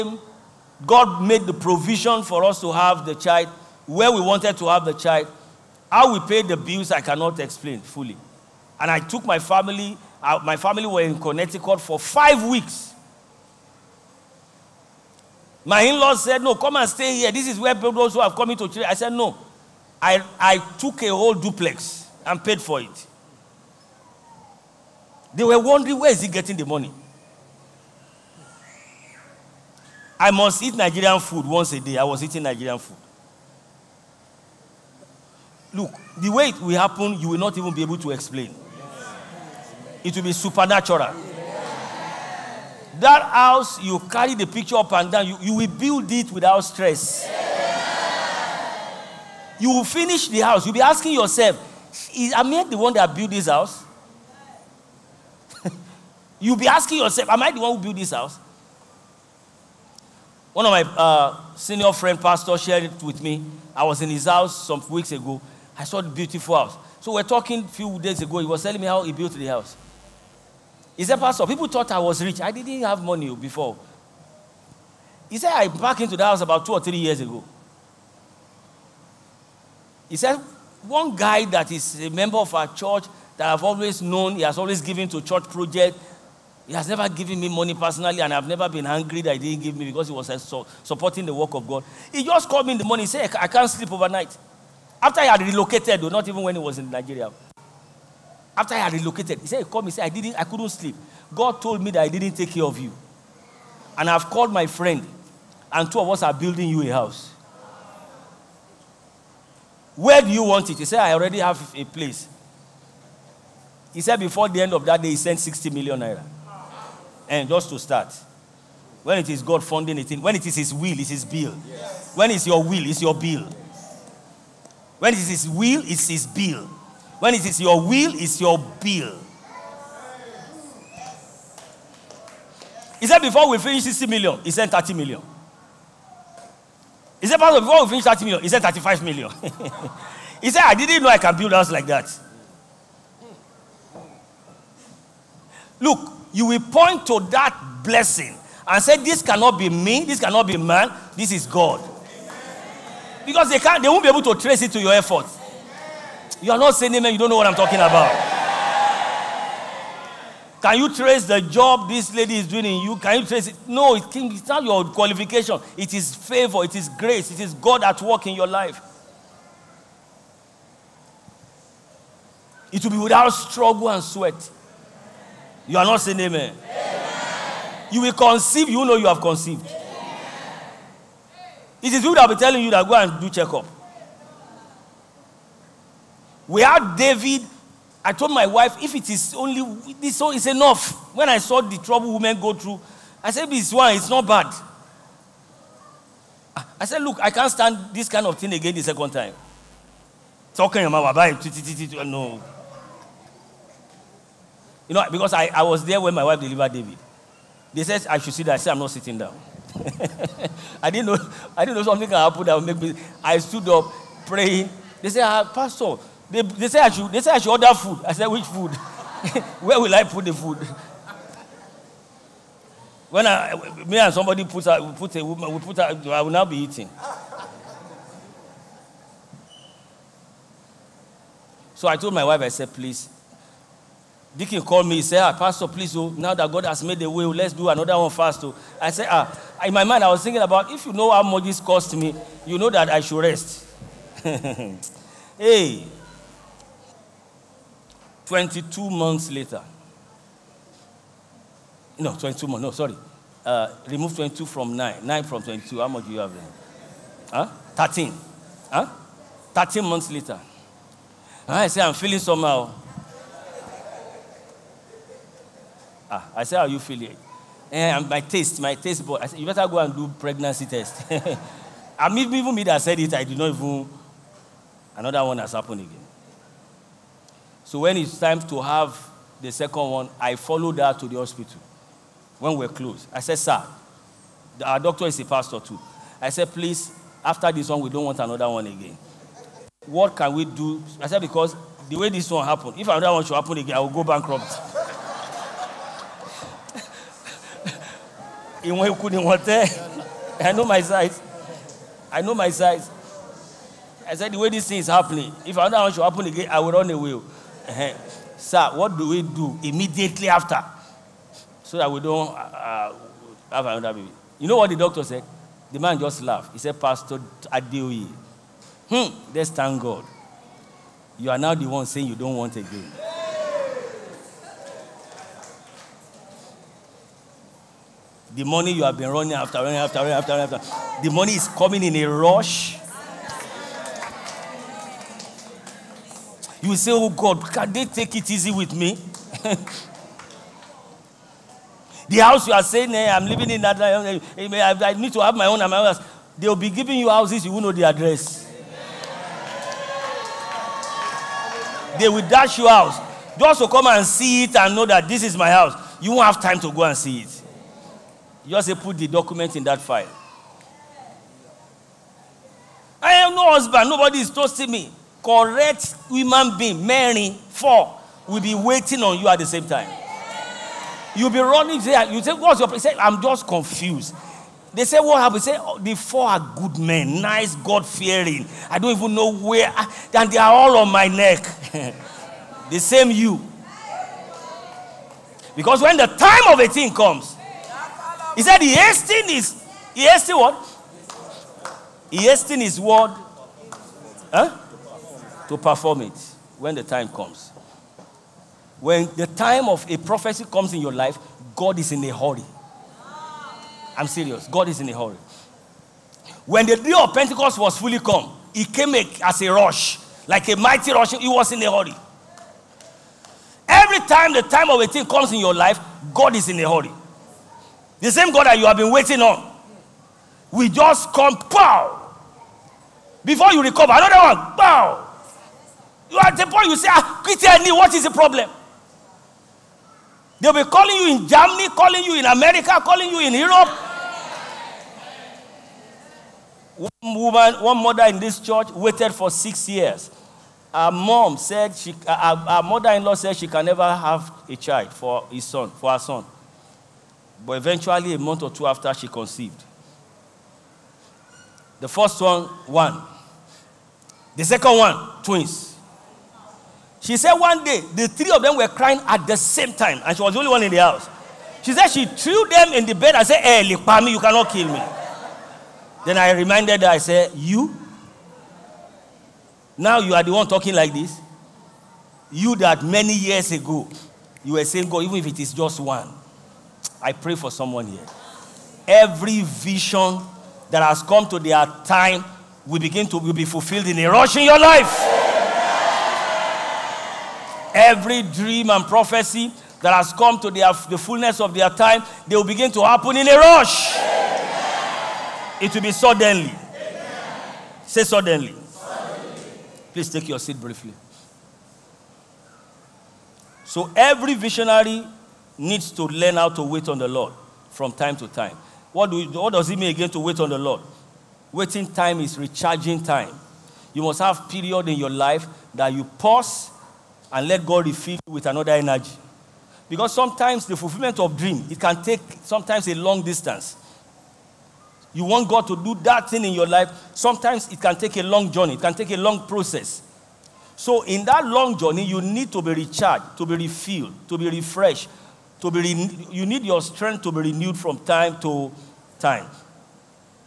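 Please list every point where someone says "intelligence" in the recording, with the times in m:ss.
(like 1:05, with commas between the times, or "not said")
not said.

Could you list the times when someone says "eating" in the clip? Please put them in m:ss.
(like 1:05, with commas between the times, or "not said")
0:32, 3:46.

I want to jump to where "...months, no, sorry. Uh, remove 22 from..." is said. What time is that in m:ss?
4:12.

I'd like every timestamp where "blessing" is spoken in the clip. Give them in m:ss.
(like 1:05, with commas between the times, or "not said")
2:27.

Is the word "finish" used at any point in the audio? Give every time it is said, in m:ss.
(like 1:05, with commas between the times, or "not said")
0:49, 2:13, 2:17.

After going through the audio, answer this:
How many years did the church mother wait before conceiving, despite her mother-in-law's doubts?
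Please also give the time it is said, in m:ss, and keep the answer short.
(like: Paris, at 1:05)
6, at 7:19.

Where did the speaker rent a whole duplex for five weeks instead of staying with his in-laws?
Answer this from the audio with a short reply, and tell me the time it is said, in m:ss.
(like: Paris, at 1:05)
Connecticut, at 0:11.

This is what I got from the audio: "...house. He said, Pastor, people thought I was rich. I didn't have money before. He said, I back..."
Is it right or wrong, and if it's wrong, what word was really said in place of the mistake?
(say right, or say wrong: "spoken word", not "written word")
right.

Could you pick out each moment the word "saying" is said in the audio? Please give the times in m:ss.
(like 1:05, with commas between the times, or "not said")
2:36, 2:56, 5:21, 5:42, 7:54.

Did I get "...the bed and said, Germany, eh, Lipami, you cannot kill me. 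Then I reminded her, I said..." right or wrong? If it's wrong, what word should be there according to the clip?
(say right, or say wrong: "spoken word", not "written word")
wrong: "Hey", not "Germany".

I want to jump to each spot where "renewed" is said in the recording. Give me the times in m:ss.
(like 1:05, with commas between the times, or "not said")
8:57.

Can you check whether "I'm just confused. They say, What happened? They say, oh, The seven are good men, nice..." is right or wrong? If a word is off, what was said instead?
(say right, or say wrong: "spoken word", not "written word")
wrong: "four", not "seven".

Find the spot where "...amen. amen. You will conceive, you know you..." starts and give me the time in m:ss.
2:56.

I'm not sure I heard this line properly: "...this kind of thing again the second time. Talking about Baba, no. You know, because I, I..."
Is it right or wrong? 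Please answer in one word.
right.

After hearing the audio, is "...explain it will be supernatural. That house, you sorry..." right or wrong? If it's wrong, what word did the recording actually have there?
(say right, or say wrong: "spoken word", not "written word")
wrong: "carry", not "sorry".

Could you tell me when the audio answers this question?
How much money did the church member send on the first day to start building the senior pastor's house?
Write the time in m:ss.
1:55.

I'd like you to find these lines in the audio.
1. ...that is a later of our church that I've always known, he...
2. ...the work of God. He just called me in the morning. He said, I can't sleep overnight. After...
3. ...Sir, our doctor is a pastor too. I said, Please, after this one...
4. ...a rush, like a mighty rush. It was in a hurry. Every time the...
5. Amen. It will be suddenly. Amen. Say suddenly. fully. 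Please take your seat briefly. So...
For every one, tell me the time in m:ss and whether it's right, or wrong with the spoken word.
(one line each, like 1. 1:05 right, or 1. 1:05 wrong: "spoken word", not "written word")
1. 1:21 wrong: "member", not "later"
2. 1:31 right
3. 4:43 right
4. 6:49 right
5. 8:13 wrong: "suddenly", not "fully".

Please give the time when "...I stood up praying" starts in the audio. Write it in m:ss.
3:33.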